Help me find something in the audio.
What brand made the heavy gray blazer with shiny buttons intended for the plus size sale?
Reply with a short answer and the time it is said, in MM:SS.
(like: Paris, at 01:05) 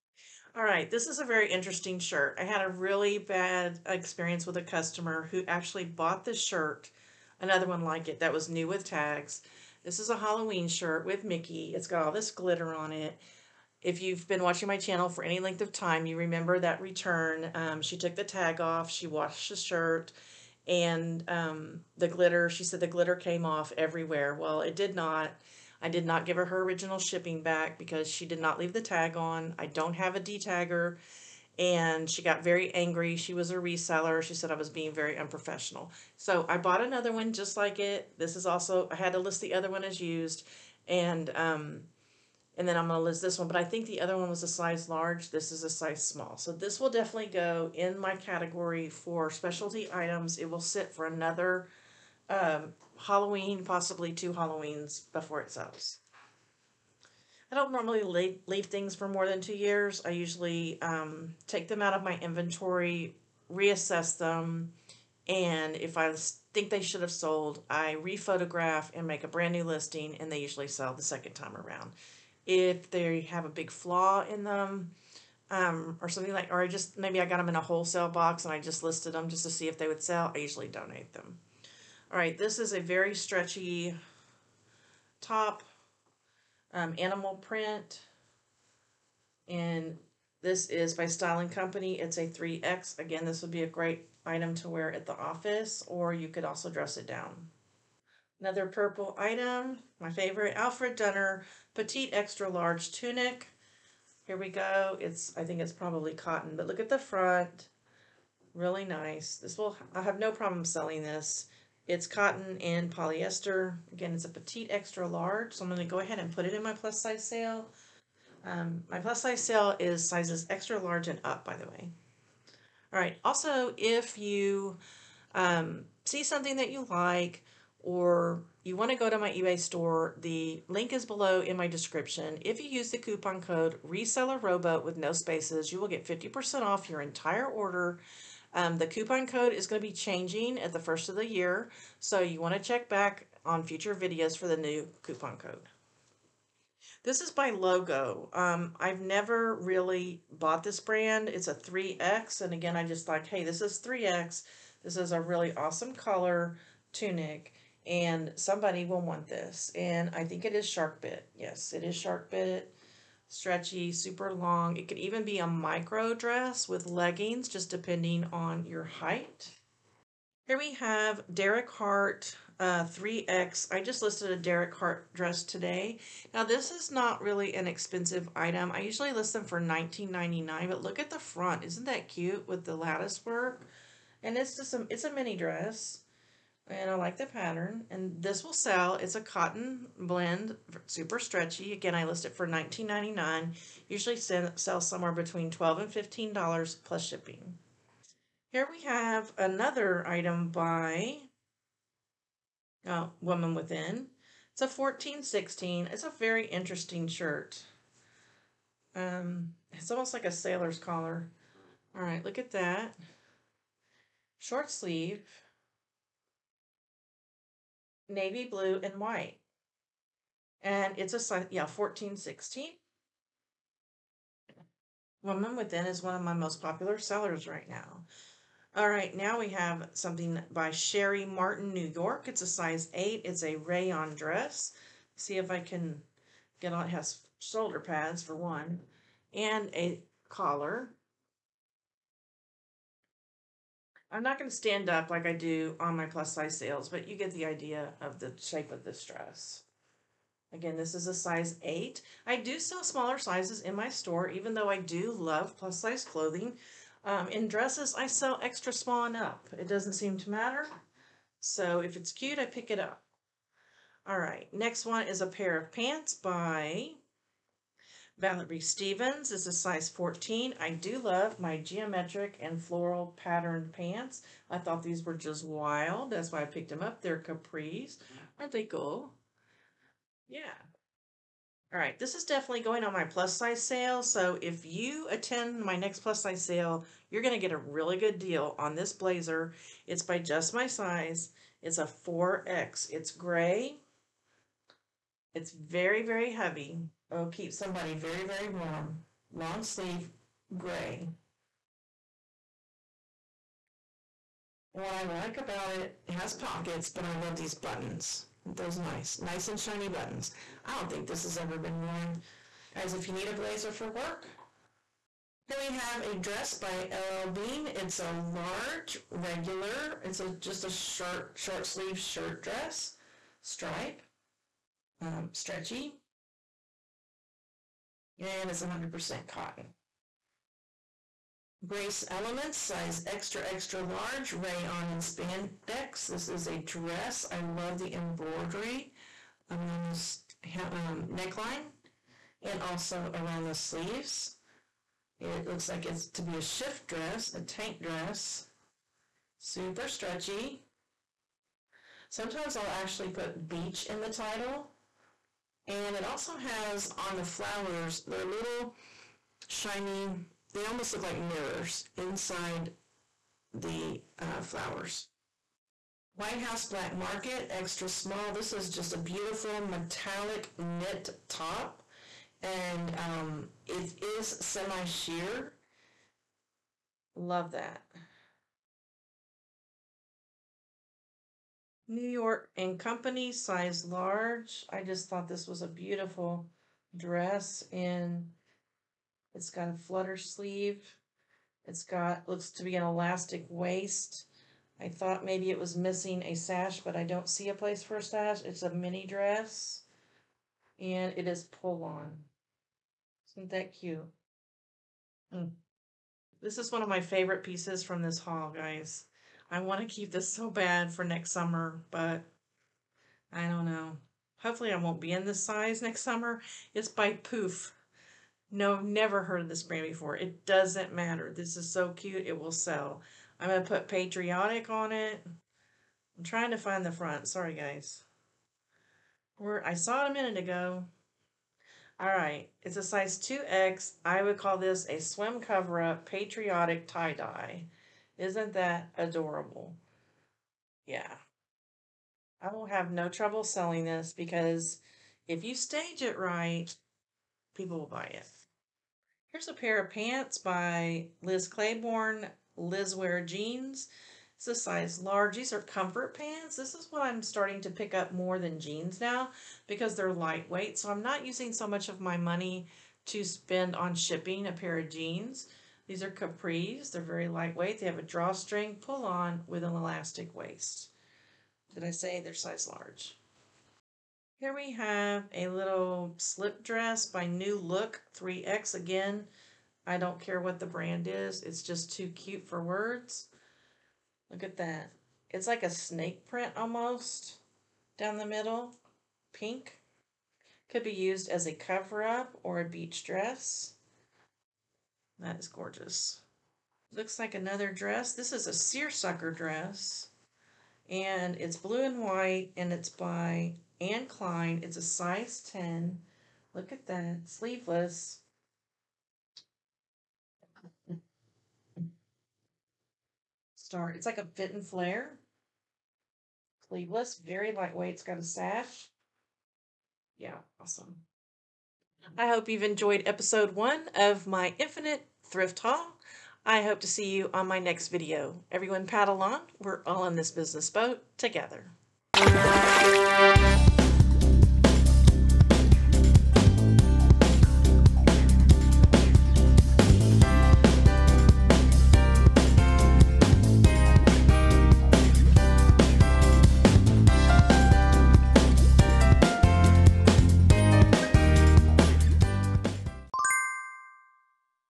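Just My Size, at 04:50.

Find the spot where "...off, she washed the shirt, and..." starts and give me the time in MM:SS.
00:18.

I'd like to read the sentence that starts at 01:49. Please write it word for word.
This will I have no problem selling this.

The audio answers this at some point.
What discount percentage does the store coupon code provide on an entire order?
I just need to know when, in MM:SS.
02:16.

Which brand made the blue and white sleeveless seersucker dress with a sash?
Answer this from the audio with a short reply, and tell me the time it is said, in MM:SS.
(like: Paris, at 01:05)
Anne Klein, at 08:23.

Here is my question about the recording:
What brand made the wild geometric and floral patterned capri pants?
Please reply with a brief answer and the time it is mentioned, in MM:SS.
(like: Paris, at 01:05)
Valerie Stevens, at 04:28.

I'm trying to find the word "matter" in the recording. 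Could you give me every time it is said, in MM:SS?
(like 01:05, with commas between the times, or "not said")
04:20, 07:00.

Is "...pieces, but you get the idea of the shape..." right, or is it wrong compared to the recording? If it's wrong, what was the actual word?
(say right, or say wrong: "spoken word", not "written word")
wrong: "sales", not "pieces".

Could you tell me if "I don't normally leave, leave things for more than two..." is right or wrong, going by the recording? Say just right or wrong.
right.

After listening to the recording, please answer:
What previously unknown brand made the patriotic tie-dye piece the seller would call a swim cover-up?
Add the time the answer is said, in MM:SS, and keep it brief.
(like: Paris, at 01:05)
Poof, at 06:57.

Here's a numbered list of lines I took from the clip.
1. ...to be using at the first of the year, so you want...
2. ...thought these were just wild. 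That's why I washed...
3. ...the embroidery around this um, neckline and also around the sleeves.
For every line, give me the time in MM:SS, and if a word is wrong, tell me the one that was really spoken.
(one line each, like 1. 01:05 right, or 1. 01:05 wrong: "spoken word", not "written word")
1. 02:19 wrong: "changing", not "using"
2. 04:34 wrong: "picked", not "washed"
3. 05:37 right.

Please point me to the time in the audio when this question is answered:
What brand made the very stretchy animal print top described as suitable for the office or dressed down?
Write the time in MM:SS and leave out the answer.
01:31.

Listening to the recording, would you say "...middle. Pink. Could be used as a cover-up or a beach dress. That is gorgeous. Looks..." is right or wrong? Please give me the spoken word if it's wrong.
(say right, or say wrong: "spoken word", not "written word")
right.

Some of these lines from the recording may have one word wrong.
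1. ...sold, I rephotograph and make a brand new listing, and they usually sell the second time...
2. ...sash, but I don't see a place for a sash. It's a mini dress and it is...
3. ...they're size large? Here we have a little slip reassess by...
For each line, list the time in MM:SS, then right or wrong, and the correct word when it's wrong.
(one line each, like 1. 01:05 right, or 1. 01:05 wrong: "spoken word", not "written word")
1. 01:07 right
2. 06:36 right
3. 07:52 wrong: "dress", not "reassess".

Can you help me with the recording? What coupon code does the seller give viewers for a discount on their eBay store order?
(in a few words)
RESELLERROBO.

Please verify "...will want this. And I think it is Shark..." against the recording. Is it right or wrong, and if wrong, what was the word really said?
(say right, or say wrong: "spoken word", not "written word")
right.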